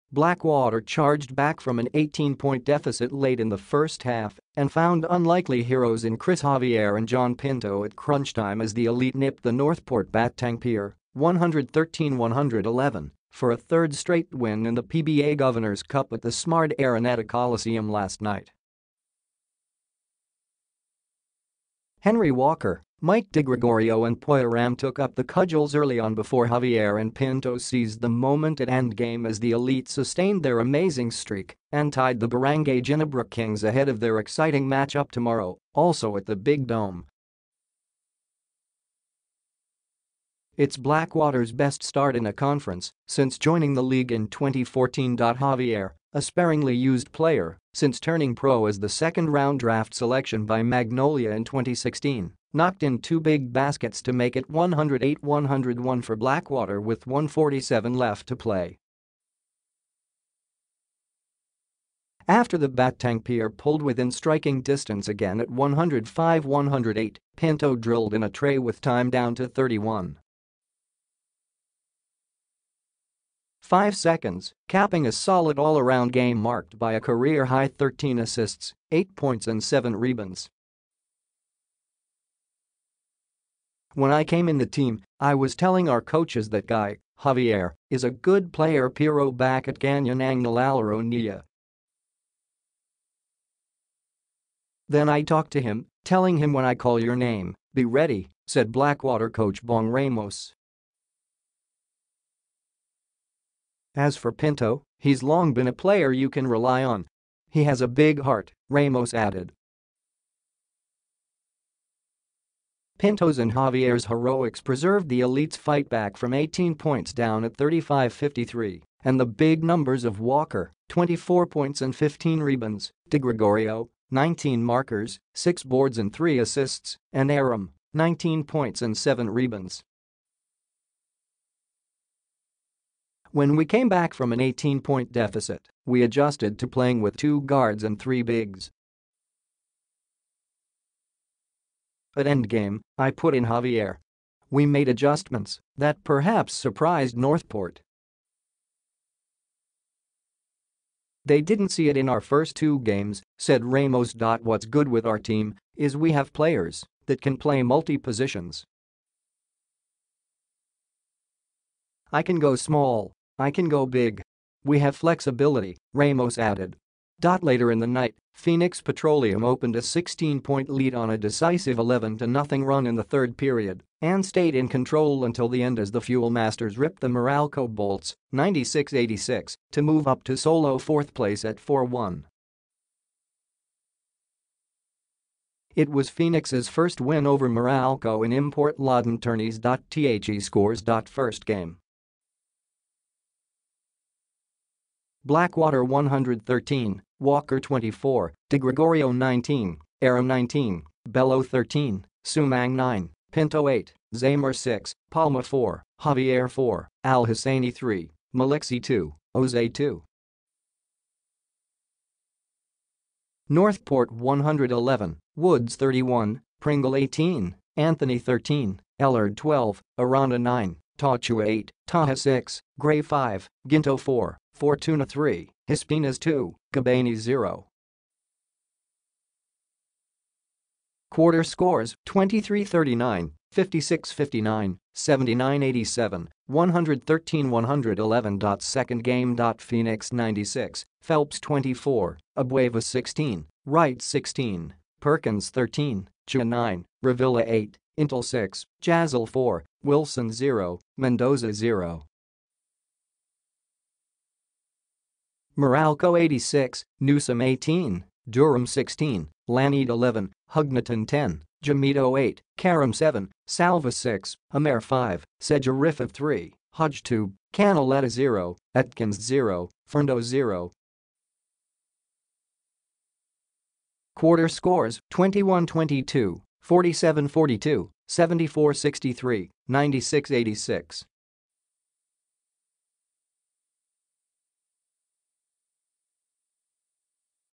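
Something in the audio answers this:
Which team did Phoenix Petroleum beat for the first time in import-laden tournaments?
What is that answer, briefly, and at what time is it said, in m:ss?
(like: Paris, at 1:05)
Meralco Bolts, at 2:57.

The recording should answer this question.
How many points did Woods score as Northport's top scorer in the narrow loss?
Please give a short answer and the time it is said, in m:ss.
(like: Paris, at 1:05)
31, at 3:35.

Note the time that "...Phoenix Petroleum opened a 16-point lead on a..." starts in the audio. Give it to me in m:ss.
2:48.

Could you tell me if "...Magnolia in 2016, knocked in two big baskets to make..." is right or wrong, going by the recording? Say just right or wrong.
right.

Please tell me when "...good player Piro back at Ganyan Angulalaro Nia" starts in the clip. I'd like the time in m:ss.
1:28.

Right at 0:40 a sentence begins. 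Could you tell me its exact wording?
It's Blackwater's best start in a conference since joining the league in 2014.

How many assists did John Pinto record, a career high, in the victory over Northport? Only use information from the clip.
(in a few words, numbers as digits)
13.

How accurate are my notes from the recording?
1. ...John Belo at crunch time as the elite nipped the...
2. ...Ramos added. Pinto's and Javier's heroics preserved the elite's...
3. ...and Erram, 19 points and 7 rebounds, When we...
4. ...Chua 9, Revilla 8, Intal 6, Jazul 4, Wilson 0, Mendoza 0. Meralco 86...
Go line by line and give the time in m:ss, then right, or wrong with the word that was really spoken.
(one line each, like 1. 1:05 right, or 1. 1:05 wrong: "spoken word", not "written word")
1. 0:07 wrong: "Pinto", not "Belo"
2. 1:48 right
3. 2:07 right
4. 4:06 right.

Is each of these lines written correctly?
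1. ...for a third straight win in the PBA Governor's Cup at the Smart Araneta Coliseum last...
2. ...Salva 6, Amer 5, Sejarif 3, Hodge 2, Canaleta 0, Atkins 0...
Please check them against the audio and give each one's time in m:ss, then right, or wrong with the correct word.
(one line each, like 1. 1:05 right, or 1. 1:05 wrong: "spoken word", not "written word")
1. 0:13 right
2. 4:23 right.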